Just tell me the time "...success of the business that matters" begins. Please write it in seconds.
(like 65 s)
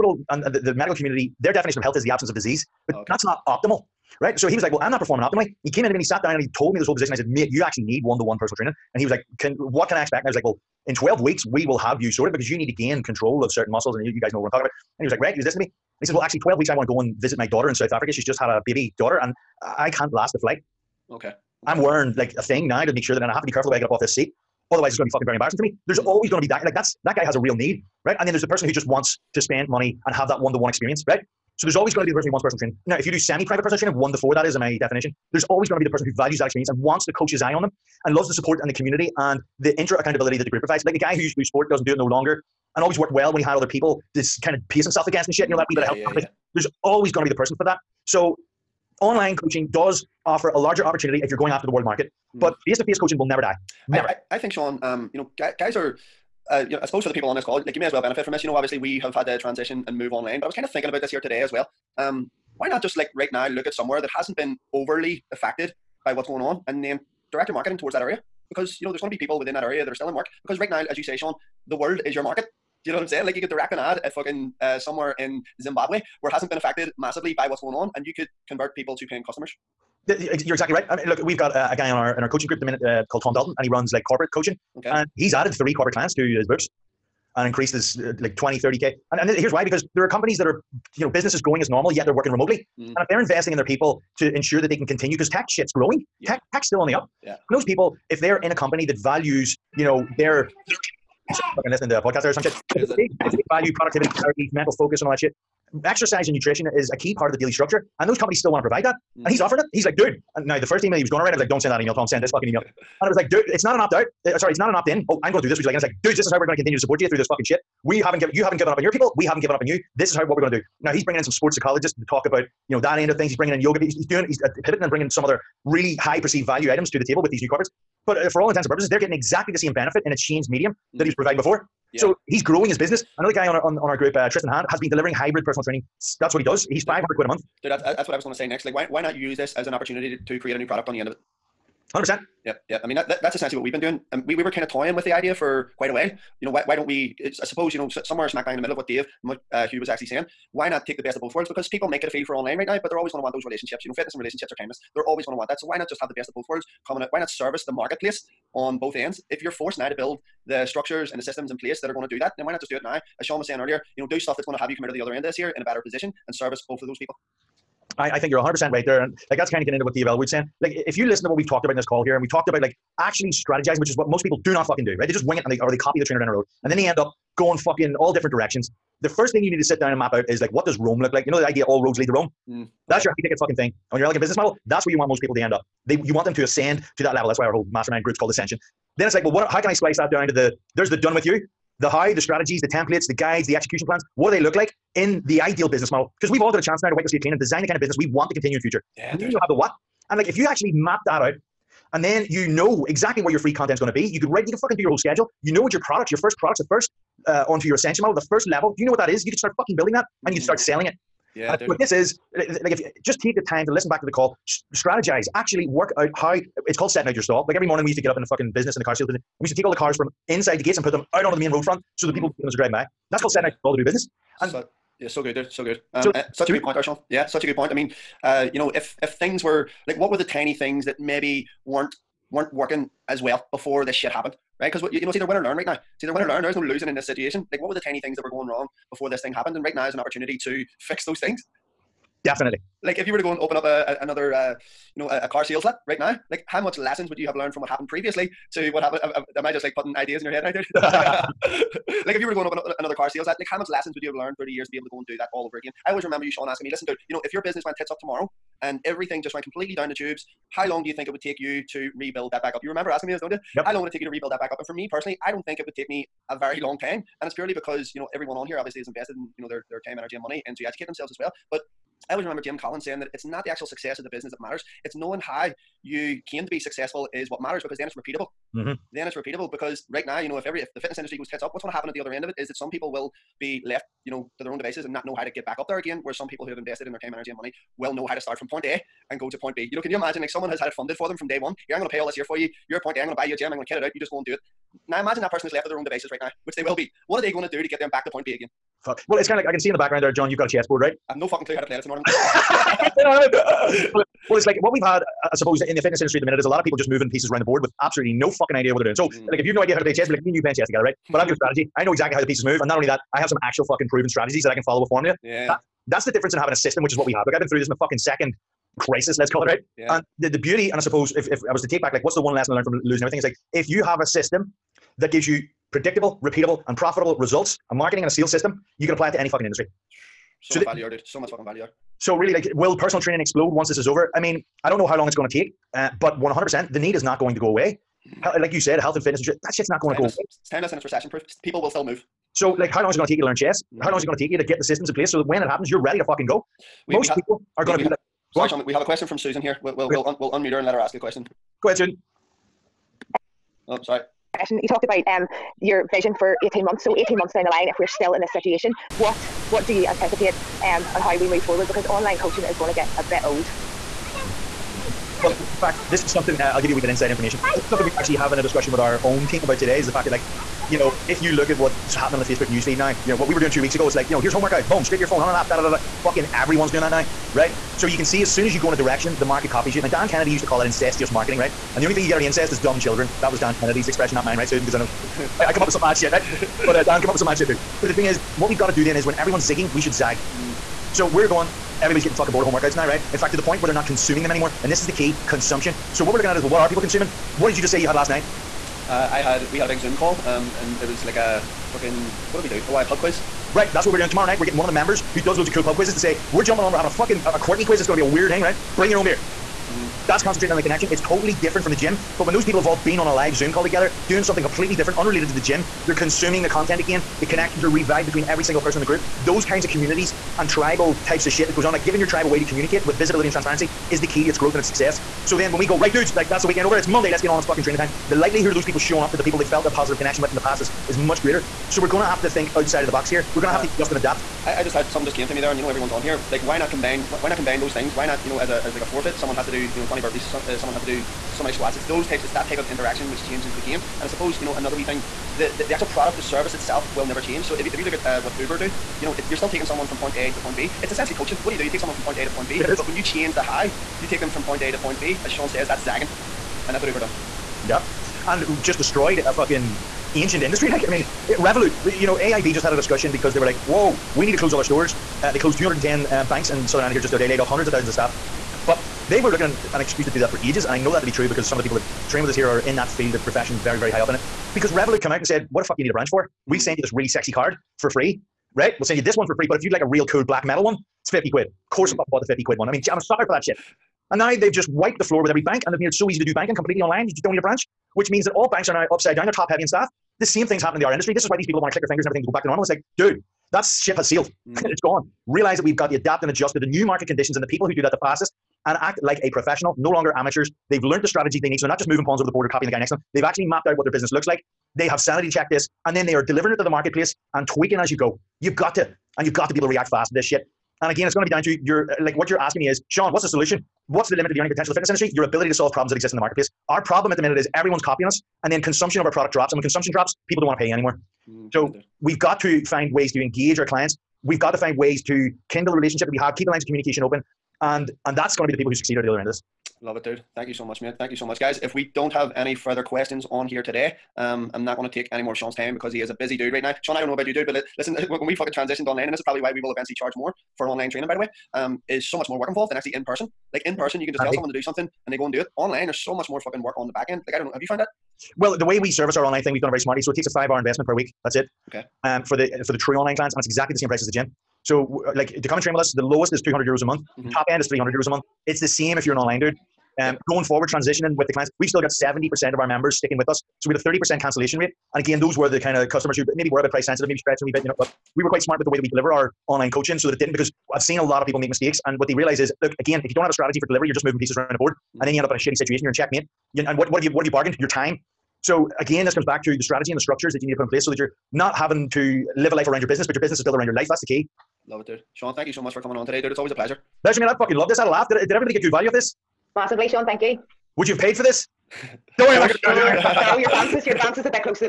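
273 s.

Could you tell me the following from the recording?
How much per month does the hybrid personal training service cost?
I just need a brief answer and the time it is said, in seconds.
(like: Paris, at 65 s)
500 pounds, at 136 s.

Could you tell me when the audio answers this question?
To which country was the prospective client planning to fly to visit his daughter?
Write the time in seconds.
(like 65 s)
17 s.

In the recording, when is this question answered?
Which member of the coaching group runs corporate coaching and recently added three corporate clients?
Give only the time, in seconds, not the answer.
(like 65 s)
83 s.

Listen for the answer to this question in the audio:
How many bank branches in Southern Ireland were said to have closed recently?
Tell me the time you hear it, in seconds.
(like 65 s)
465 s.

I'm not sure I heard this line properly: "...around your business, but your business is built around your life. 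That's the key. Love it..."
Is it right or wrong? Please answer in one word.
right.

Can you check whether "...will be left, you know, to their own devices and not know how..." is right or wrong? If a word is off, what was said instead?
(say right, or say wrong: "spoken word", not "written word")
right.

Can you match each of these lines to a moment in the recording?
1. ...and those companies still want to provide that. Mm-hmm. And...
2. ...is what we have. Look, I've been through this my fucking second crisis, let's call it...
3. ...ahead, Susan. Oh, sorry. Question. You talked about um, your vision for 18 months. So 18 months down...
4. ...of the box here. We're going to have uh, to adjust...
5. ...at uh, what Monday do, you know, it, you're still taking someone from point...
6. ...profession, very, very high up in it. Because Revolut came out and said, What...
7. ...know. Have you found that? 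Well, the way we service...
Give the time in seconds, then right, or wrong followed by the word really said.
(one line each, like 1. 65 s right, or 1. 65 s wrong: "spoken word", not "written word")
1. 108 s right
2. 316 s right
3. 351 s right
4. 432 s right
5. 447 s wrong: "Uber", not "Monday"
6. 473 s right
7. 547 s right.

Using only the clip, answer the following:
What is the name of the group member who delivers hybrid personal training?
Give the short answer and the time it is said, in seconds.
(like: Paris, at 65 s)
Tristan Hand, at 134 s.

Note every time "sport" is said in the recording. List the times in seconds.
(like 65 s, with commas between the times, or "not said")
41 s, 121 s.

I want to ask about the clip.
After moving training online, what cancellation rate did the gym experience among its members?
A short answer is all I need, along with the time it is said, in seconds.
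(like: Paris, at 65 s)
30%, at 563 s.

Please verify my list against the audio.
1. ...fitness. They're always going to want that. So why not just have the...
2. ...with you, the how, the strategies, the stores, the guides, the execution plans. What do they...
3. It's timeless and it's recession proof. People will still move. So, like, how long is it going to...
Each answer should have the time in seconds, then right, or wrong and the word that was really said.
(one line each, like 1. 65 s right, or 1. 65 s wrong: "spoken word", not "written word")
1. 154 s wrong: "timeless", not "fitness"
2. 191 s wrong: "templates", not "stores"
3. 340 s right.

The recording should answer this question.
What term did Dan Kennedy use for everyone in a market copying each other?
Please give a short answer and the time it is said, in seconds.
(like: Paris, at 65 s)
incestuous marketing, at 380 s.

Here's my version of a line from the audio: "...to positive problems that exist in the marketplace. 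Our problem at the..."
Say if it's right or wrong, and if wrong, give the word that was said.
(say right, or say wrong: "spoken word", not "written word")
wrong: "solve", not "positive".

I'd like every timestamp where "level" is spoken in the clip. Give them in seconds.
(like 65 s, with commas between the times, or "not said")
187 s, 208 s.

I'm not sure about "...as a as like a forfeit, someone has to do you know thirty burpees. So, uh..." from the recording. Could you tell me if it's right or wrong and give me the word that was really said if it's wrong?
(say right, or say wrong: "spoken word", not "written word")
wrong: "twenty", not "thirty".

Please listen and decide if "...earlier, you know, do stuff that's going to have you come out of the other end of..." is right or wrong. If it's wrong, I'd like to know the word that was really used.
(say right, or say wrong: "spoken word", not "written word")
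right.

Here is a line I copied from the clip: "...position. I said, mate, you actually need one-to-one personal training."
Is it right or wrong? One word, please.
right.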